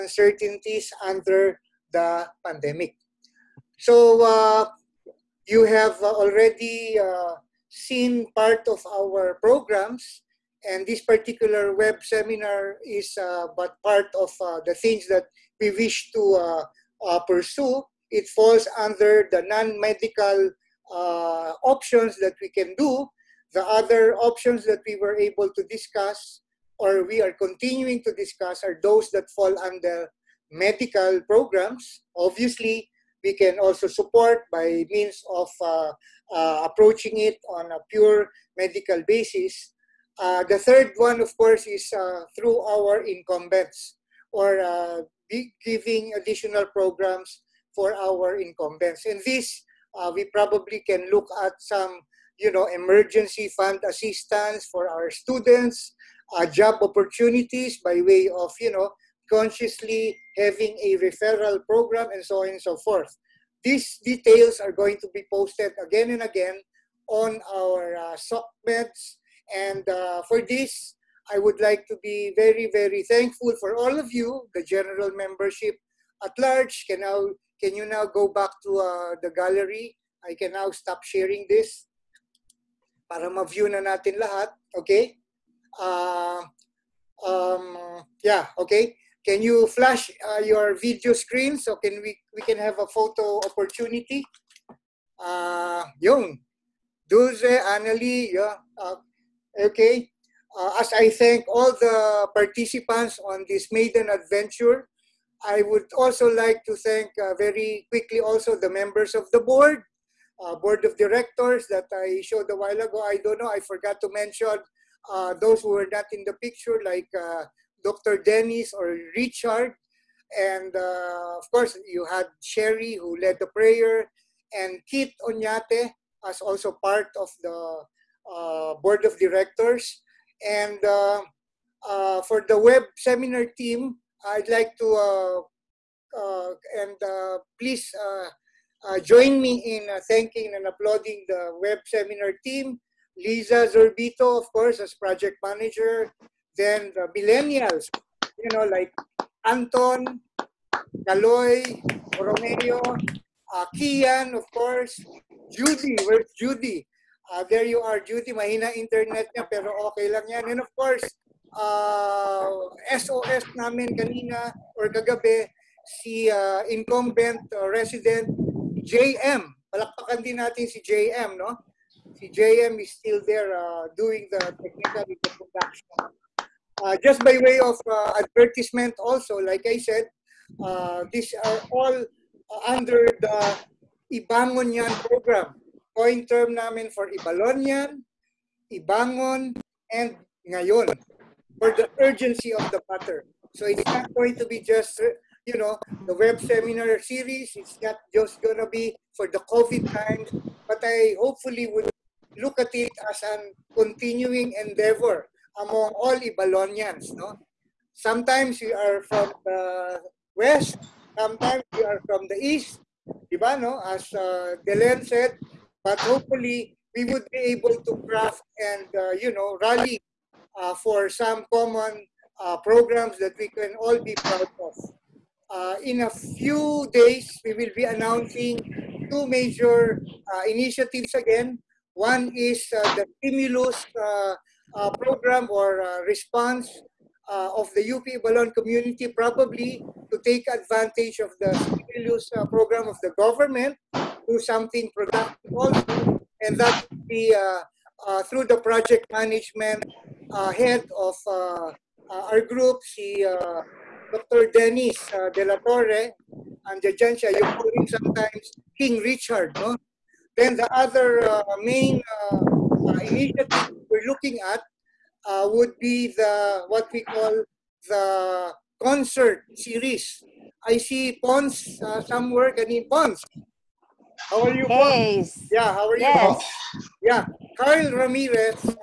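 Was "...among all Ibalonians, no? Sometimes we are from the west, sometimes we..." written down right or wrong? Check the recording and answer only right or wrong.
right.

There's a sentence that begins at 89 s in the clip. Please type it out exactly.
Can you flash uh, your video screen so can we we can have a photo opportunity?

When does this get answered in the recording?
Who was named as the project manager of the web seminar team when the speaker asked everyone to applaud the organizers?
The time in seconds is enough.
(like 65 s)
143 s.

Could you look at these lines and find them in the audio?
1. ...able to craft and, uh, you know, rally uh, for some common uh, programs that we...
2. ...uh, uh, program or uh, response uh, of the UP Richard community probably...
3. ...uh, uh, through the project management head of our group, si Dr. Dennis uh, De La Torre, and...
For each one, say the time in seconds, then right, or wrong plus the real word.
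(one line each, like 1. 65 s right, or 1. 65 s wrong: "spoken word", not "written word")
1. 217 s right
2. 233 s wrong: "Ibalon", not "Richard"
3. 247 s right.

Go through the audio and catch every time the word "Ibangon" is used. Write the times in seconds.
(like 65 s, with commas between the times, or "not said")
184 s, 188 s.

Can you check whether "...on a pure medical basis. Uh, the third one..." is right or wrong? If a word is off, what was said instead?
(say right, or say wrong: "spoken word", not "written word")
right.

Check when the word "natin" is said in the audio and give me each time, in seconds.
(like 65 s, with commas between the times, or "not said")
83 s, 170 s.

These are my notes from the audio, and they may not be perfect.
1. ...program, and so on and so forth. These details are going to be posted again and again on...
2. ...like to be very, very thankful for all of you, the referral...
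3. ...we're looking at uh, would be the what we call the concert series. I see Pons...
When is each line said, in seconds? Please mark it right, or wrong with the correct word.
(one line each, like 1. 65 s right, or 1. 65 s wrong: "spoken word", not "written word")
1. 61 s right
2. 71 s wrong: "general", not "referral"
3. 263 s right.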